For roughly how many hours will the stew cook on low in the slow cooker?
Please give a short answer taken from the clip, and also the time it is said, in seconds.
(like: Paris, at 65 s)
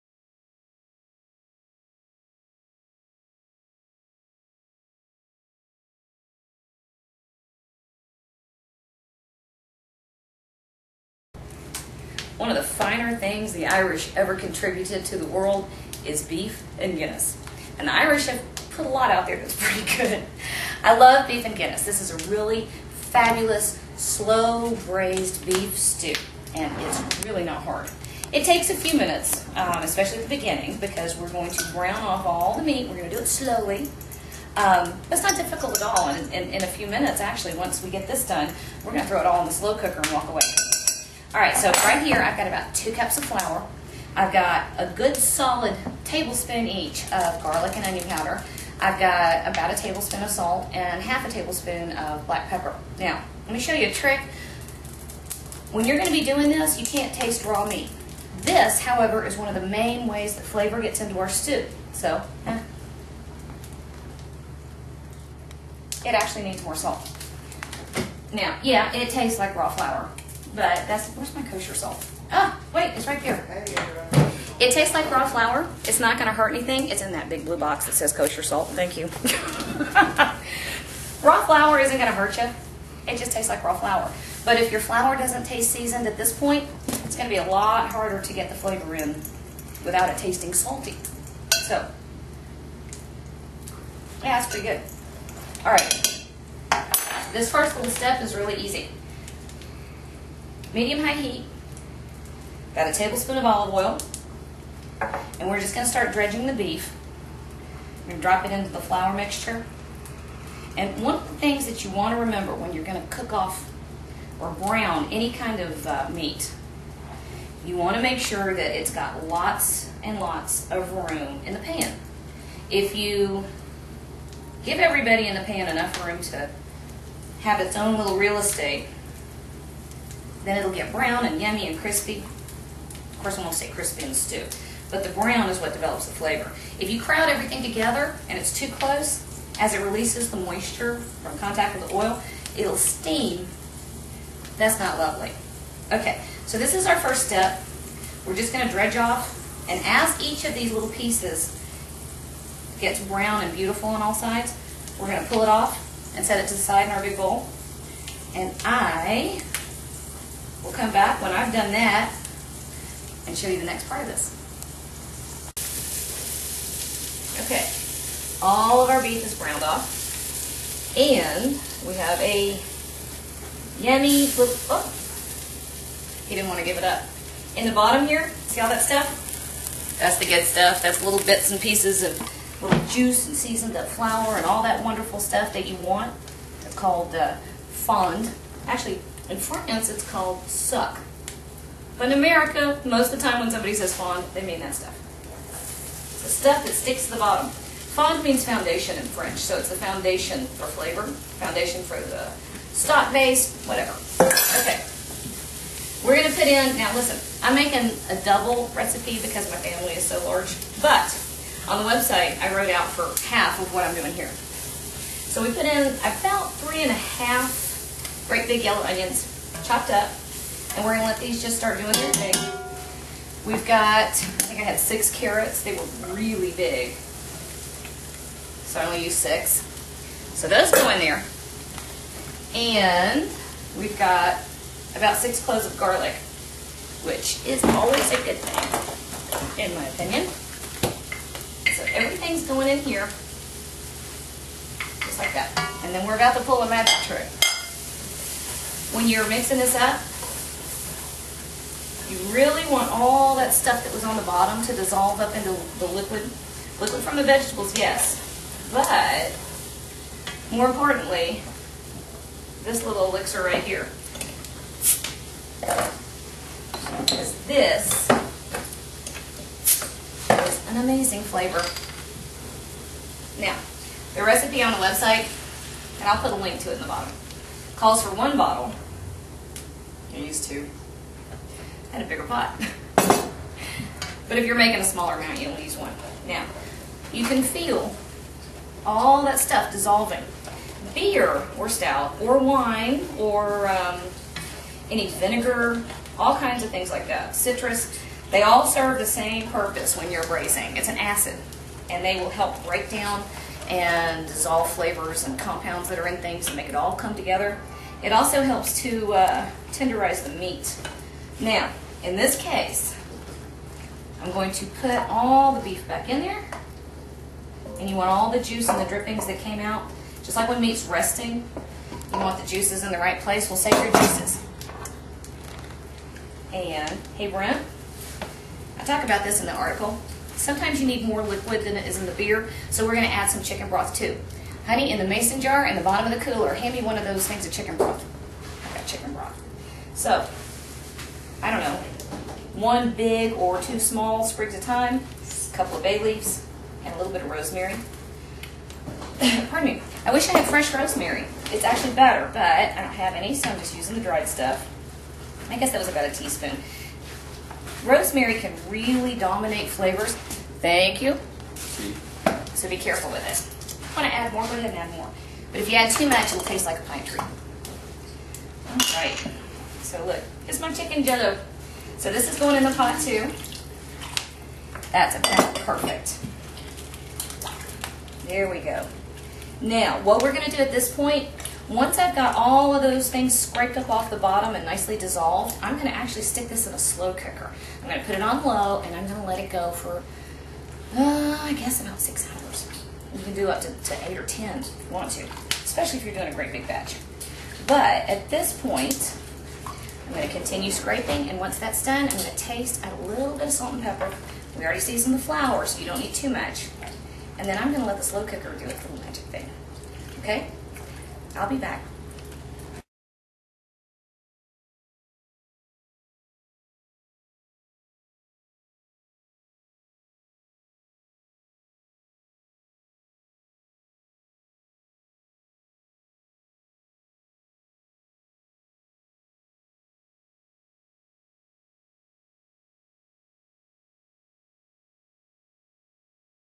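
6 hours, at 391 s.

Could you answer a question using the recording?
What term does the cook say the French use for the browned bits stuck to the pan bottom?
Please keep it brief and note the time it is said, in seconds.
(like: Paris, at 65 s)
sucs, at 190 s.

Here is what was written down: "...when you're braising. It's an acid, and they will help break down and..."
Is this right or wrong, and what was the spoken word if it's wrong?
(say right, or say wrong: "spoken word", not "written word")
right.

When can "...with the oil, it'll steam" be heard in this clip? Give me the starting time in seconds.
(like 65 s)
141 s.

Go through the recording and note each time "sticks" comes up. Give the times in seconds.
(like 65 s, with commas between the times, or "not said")
196 s, 386 s.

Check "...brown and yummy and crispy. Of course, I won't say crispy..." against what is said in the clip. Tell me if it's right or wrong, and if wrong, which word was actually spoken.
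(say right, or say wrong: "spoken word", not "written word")
right.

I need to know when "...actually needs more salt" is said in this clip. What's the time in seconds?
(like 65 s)
66 s.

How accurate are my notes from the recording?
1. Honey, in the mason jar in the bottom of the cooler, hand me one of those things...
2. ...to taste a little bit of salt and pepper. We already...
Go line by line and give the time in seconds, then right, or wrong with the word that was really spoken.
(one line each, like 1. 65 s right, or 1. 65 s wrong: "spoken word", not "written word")
1. 334 s right
2. 402 s right.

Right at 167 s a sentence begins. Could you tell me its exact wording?
Okay, all of our beef is browned off.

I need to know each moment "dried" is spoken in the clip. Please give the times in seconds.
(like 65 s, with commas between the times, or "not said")
354 s.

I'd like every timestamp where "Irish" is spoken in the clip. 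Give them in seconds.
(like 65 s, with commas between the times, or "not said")
13 s, 17 s.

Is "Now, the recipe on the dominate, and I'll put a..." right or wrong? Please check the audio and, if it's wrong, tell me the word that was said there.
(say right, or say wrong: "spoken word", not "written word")
wrong: "website", not "dominate".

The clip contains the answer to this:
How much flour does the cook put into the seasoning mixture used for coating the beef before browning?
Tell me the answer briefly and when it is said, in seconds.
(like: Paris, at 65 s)
2 cups, at 42 s.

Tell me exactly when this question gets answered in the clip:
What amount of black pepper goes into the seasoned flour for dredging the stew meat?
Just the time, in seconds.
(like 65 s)
51 s.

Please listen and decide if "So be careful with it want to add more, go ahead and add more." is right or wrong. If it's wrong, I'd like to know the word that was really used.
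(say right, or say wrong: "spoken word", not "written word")
right.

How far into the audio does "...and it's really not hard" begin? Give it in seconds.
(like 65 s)
26 s.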